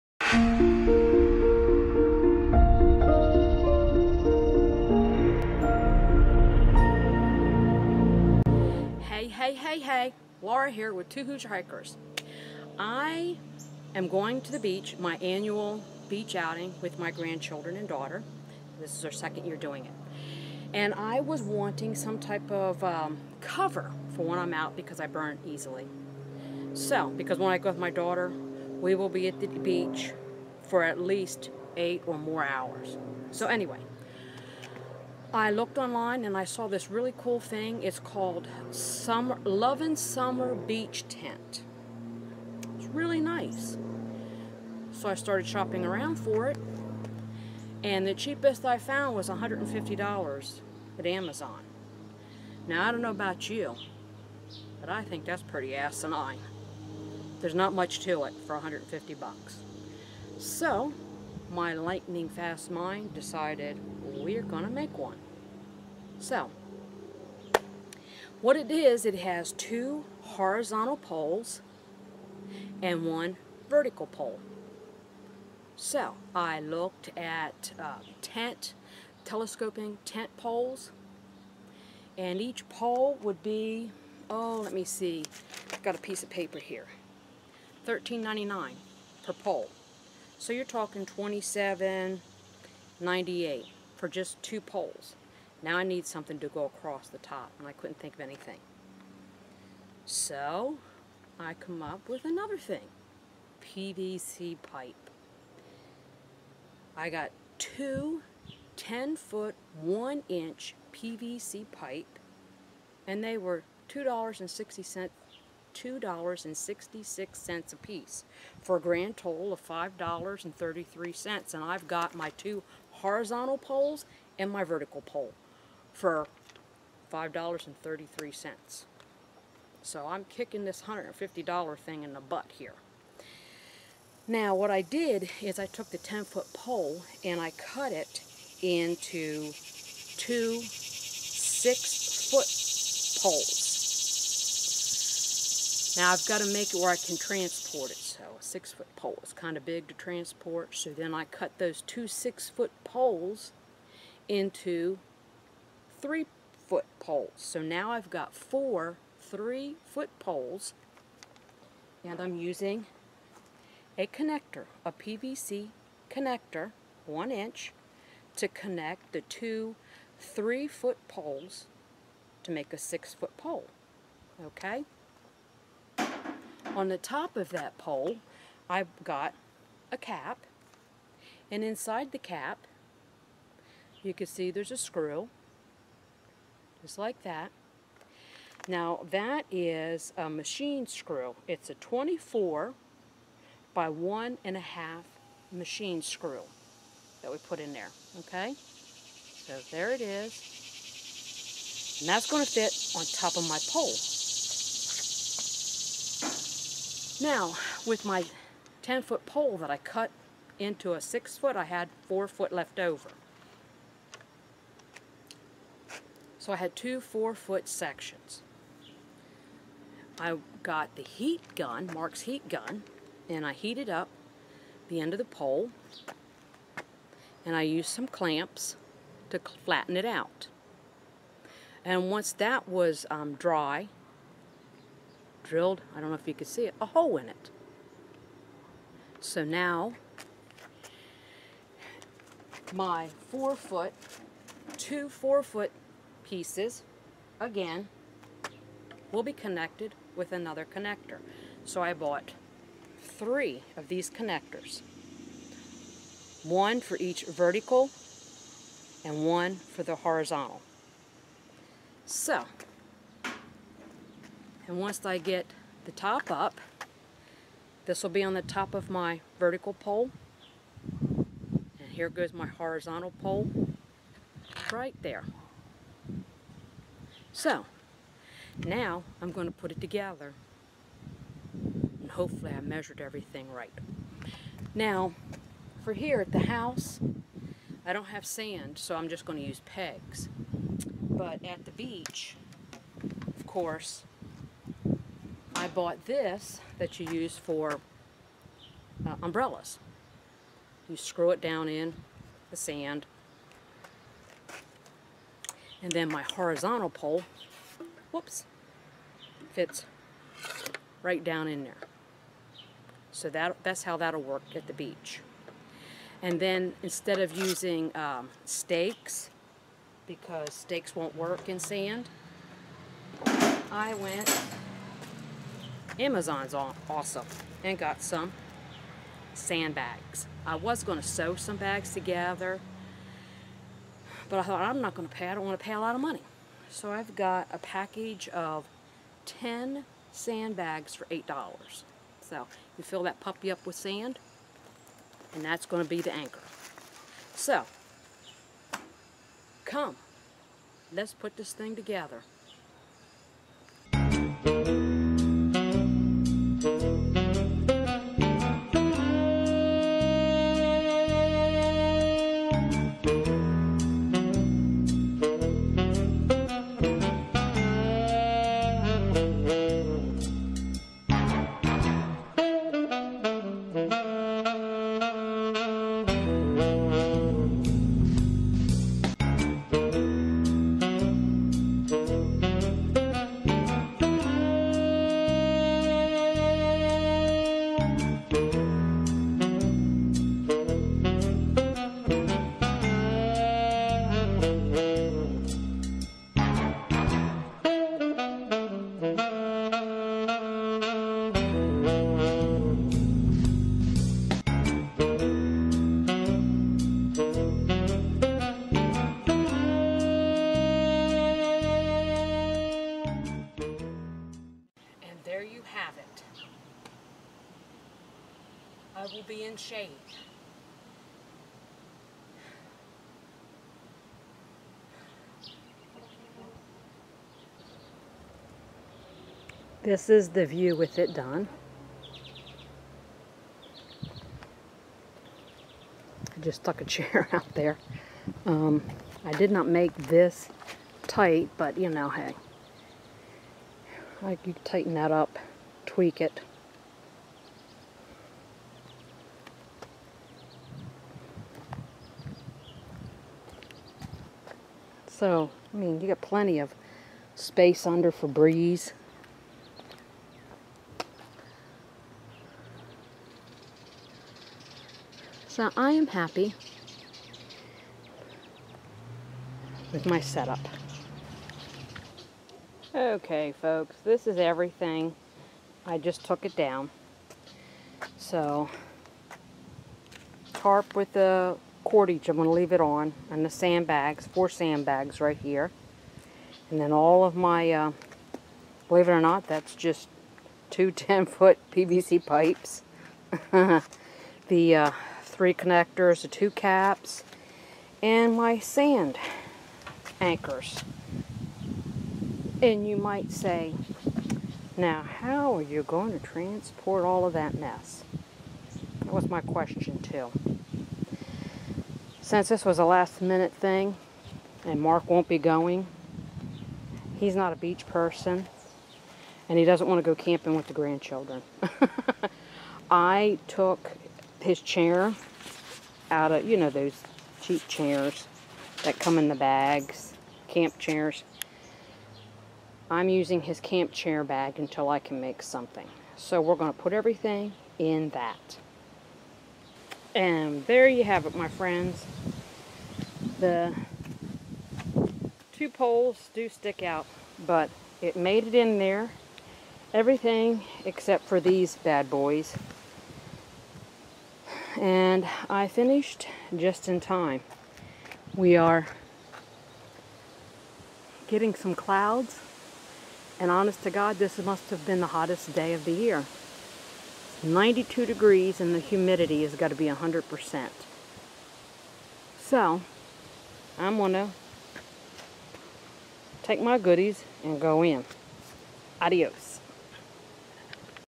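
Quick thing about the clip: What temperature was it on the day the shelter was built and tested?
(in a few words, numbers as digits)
92 degrees.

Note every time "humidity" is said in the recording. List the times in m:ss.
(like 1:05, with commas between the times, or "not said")
9:28.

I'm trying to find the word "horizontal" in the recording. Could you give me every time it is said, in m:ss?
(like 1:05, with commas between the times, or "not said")
1:10, 2:02, 4:19, 4:32, 5:06.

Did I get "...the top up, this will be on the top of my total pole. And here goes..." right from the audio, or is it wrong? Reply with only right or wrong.
wrong.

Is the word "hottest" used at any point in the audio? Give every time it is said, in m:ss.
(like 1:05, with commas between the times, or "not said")
9:25.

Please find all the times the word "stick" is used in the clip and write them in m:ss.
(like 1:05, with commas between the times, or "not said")
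9:06.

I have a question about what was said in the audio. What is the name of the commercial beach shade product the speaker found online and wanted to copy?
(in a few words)
Summer Lovin' Summer Beach Tent.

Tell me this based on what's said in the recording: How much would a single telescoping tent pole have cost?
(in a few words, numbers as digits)
$13.99.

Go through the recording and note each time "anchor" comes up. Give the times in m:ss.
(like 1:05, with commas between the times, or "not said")
5:46, 8:20.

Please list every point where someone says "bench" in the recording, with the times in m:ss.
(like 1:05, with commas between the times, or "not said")
not said.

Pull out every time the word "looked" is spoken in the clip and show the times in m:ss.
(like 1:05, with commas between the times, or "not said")
0:35, 1:16.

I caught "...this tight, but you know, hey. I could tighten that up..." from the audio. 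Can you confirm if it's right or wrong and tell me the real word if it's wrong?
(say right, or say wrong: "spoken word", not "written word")
right.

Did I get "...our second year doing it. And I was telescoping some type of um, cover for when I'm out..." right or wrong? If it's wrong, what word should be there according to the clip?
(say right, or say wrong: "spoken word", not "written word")
wrong: "wanting", not "telescoping".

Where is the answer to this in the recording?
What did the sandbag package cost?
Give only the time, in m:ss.
5:41.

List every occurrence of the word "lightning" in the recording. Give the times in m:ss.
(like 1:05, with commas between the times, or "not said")
1:01.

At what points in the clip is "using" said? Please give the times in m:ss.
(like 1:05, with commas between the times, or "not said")
2:42, 5:17, 8:53.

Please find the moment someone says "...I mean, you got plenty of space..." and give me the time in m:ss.
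7:35.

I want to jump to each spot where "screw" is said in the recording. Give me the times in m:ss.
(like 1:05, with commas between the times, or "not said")
3:04, 3:10, 3:16, 5:00.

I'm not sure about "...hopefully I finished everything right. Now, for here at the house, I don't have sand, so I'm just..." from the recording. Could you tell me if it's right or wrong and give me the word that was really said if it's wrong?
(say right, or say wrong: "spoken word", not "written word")
wrong: "measured", not "finished".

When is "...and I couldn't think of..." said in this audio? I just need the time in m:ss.
1:37.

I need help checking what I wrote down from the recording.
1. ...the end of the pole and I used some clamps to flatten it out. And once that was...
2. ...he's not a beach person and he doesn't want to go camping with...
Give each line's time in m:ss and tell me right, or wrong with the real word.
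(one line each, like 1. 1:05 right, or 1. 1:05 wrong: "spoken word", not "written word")
1. 3:44 right
2. 8:37 right.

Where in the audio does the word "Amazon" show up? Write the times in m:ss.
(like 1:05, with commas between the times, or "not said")
0:51, 5:26.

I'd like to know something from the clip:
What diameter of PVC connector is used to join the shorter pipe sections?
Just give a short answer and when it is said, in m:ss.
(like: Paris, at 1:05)
1 inch, at 2:47.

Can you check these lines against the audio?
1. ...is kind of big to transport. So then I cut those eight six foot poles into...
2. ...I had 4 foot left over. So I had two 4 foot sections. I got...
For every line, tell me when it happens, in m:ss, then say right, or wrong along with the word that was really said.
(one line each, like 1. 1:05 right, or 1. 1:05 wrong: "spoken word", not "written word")
1. 2:29 wrong: "two", not "eight"
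2. 3:31 right.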